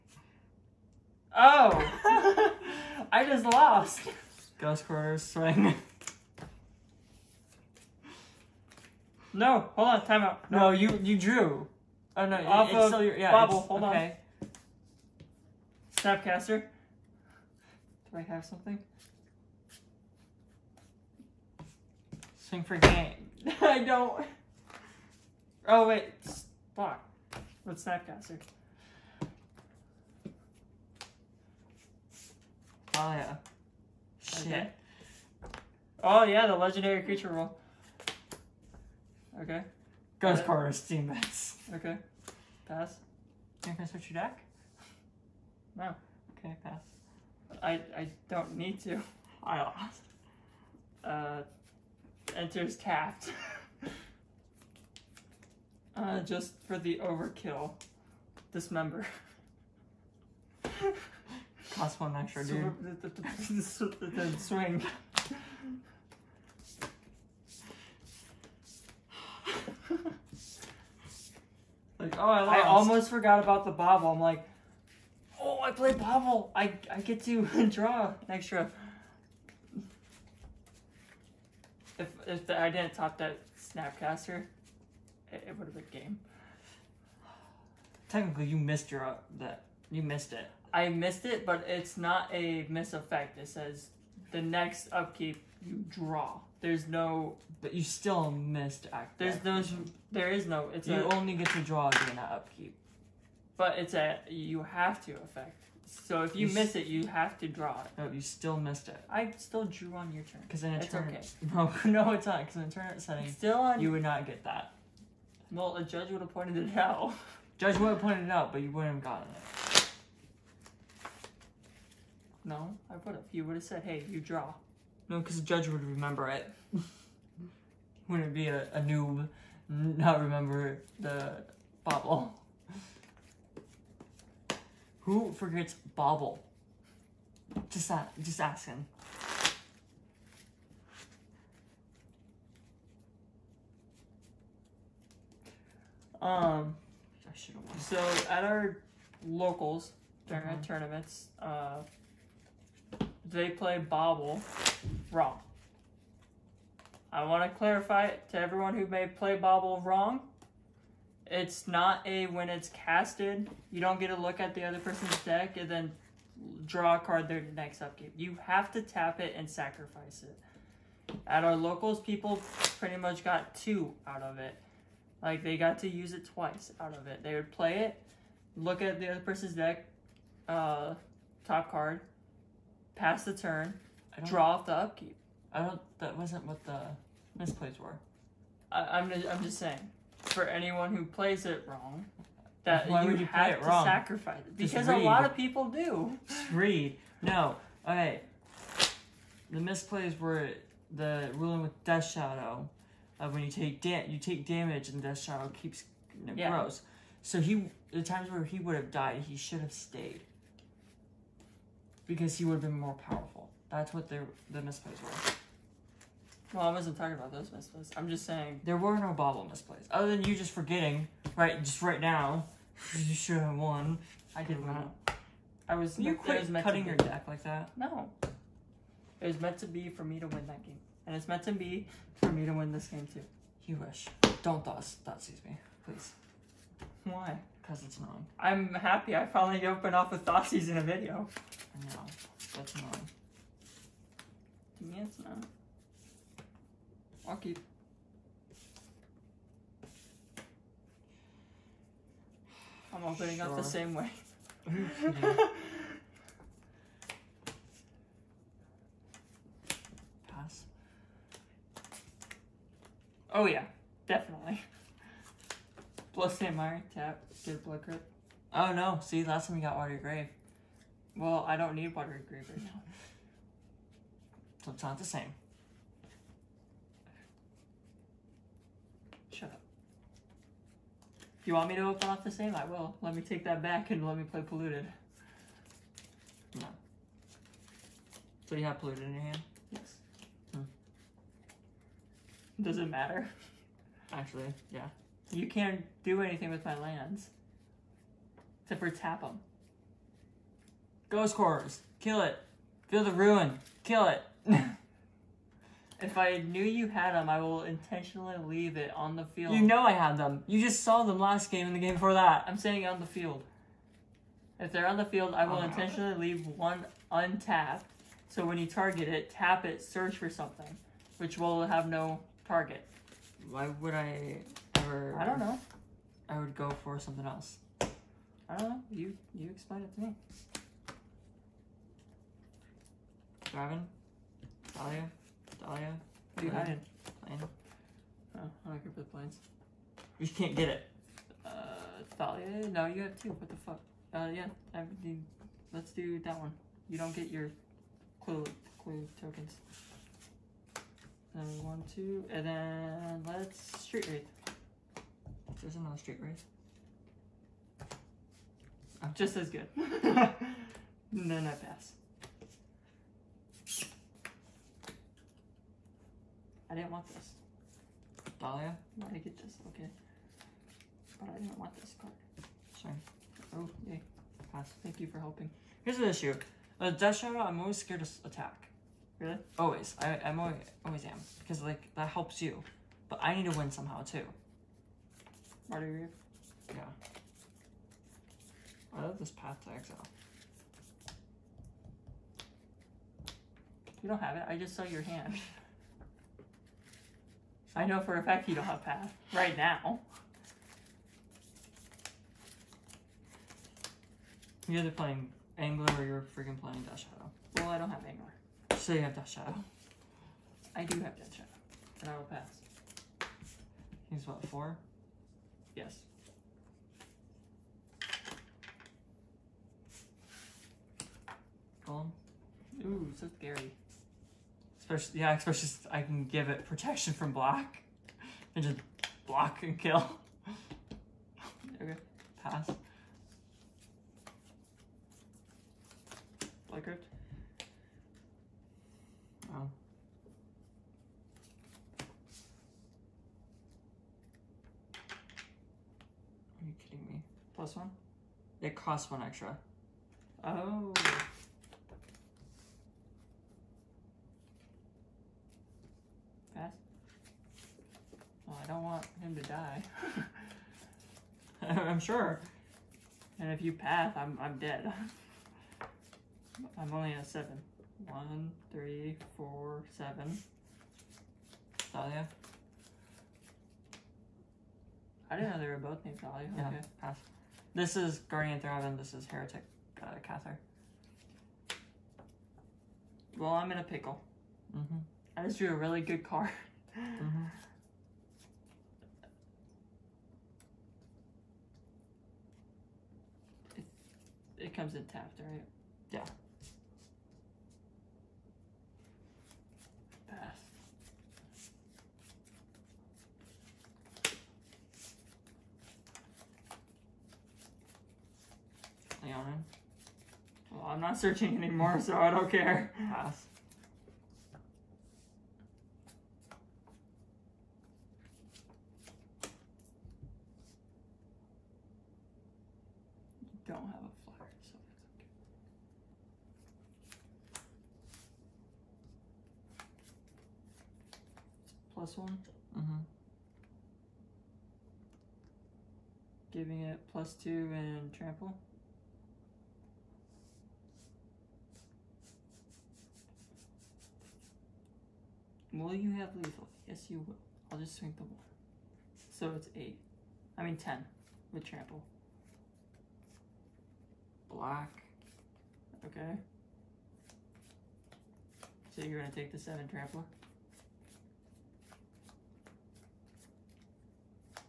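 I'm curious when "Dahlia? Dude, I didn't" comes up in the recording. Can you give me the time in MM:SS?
05:35.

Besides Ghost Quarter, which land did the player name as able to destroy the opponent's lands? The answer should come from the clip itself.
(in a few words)
Field of Ruin.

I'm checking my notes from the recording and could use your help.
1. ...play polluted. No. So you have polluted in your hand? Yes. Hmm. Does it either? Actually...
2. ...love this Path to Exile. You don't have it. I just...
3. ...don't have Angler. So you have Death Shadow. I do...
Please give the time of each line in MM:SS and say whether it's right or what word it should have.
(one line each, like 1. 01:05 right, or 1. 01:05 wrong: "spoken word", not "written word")
1. 04:44 wrong: "matter", not "either"
2. 06:29 right
3. 06:47 right.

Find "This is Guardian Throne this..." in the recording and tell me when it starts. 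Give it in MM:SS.
07:57.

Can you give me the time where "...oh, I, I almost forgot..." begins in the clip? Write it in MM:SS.
01:12.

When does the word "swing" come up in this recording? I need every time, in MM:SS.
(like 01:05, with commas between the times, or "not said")
00:05, 00:22, 01:04, 09:07.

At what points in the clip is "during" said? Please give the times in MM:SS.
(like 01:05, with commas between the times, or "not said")
01:41, 02:30.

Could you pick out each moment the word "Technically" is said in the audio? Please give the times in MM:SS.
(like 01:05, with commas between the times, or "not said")
01:28.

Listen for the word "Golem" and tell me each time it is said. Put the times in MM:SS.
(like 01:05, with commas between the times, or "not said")
07:01.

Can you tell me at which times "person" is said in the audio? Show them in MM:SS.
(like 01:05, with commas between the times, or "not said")
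02:44, 02:59.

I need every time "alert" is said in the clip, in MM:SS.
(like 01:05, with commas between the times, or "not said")
not said.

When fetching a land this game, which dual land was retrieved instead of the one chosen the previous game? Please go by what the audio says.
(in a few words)
Blood Crypt.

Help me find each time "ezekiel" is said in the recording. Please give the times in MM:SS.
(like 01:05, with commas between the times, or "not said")
not said.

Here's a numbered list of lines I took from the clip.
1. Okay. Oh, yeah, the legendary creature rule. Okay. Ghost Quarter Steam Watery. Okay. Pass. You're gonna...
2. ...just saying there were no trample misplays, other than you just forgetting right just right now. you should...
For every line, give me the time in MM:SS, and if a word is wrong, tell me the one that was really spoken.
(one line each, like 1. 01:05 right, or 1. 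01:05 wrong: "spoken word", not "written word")
1. 00:34 wrong: "Vents", not "Watery"
2. 03:38 wrong: "bauble", not "trample".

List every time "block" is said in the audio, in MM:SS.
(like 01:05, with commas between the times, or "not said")
00:26, 07:09.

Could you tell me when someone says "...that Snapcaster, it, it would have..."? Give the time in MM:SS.
01:23.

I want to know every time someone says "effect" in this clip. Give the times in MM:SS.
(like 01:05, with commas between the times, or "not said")
01:32, 01:45.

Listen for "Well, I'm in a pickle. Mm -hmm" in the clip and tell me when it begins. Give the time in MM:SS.
08:03.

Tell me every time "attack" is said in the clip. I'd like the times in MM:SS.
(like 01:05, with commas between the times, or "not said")
06:18.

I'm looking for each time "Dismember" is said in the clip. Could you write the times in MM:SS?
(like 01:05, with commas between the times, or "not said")
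00:58.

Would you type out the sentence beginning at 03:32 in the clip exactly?
Because he would have been more powerful.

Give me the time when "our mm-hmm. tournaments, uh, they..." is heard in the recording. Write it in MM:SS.
02:30.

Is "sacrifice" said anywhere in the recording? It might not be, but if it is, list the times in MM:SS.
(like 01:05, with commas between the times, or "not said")
02:49, 03:13.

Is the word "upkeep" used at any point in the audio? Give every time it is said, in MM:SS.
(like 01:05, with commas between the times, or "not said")
01:34, 01:42, 02:47, 03:04.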